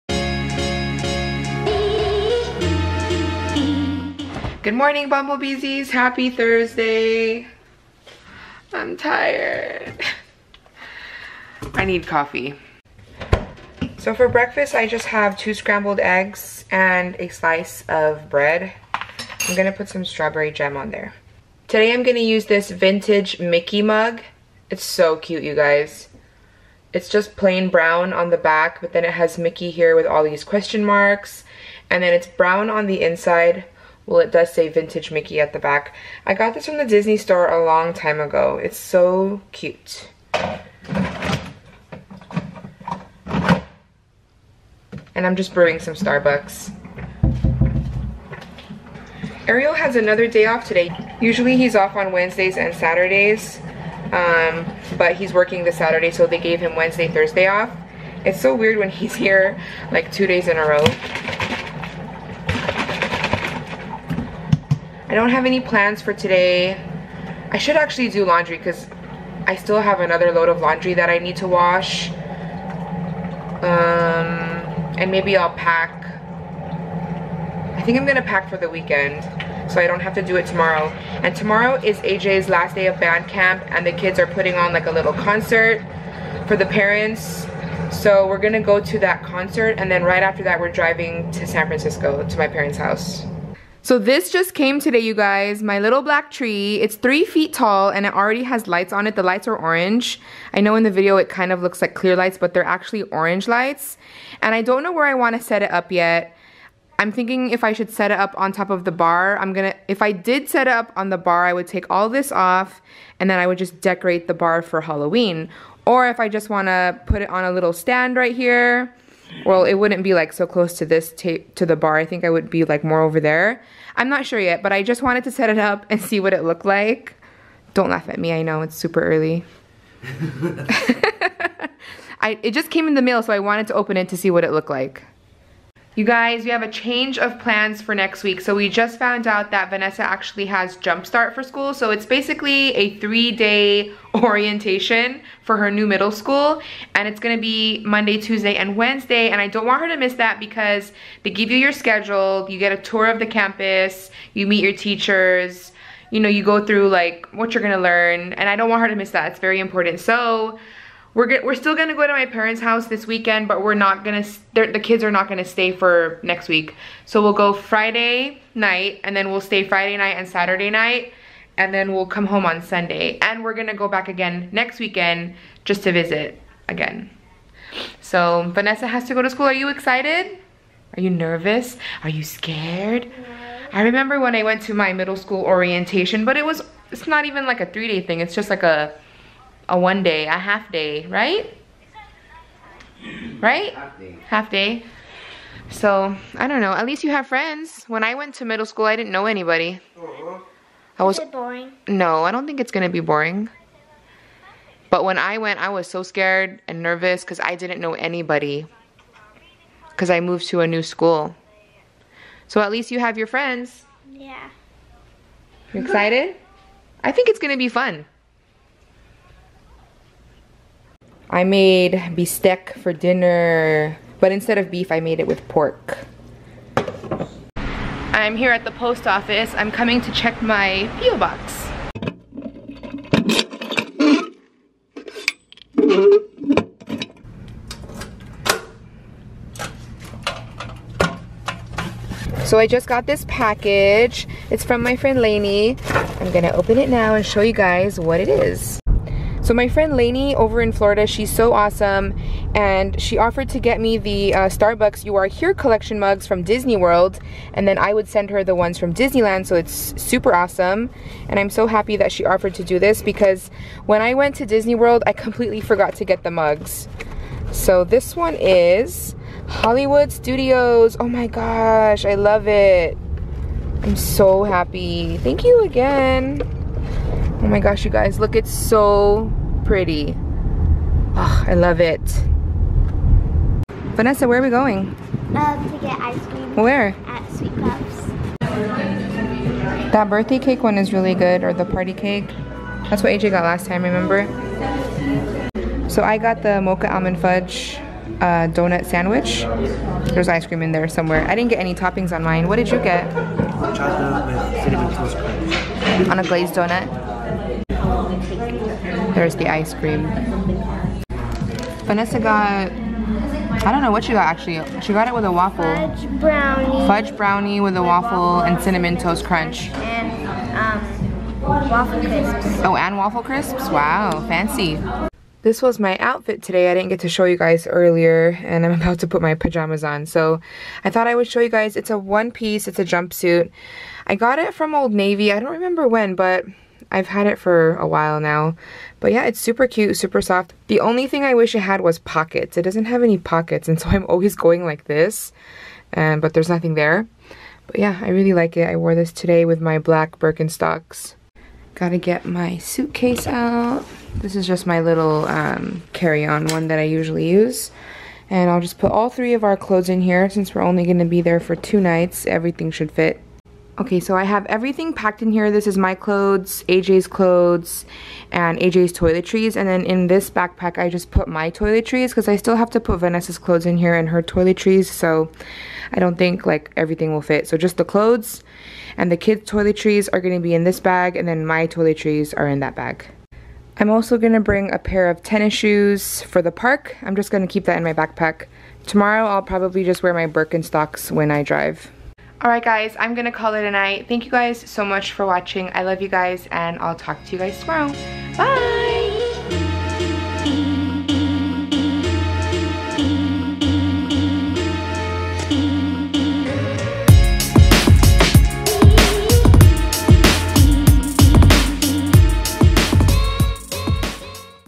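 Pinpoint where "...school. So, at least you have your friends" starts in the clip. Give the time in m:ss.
3:30.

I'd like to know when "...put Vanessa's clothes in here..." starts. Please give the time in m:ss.
6:12.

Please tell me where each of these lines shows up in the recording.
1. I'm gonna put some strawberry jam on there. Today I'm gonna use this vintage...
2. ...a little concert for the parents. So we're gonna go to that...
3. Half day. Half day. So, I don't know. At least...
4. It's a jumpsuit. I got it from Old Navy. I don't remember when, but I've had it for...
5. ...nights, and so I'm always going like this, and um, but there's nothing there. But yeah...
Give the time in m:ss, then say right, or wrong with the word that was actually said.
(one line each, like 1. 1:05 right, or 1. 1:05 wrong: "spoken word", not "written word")
1. 0:18 right
2. 1:24 right
3. 3:13 right
4. 5:32 right
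5. 5:43 wrong: "pockets", not "nights".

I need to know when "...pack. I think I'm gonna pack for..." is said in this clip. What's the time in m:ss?
1:15.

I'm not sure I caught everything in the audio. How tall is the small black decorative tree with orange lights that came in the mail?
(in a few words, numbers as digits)
3 feet.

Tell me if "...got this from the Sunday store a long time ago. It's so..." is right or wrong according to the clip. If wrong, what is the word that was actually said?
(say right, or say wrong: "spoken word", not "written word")
wrong: "Disney", not "Sunday".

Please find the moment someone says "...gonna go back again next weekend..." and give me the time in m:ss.
2:53.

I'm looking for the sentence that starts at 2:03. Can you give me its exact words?
I'm not sure yet, but I just wanted to set it up and see what it looked like.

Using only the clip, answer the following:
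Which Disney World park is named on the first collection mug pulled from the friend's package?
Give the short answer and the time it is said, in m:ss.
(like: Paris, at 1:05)
Hollywood Studios, at 4:29.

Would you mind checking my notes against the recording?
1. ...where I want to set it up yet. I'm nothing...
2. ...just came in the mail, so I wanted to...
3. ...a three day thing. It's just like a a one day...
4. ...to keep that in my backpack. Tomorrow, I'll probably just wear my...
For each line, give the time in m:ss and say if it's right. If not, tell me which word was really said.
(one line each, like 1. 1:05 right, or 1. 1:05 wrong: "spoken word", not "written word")
1. 1:44 wrong: "thinking", not "nothing"
2. 2:12 right
3. 3:07 right
4. 6:27 right.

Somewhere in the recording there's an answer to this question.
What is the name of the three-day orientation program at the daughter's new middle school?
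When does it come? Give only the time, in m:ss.
2:20.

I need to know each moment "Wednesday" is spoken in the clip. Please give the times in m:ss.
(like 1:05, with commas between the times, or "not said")
0:52, 0:56, 2:28.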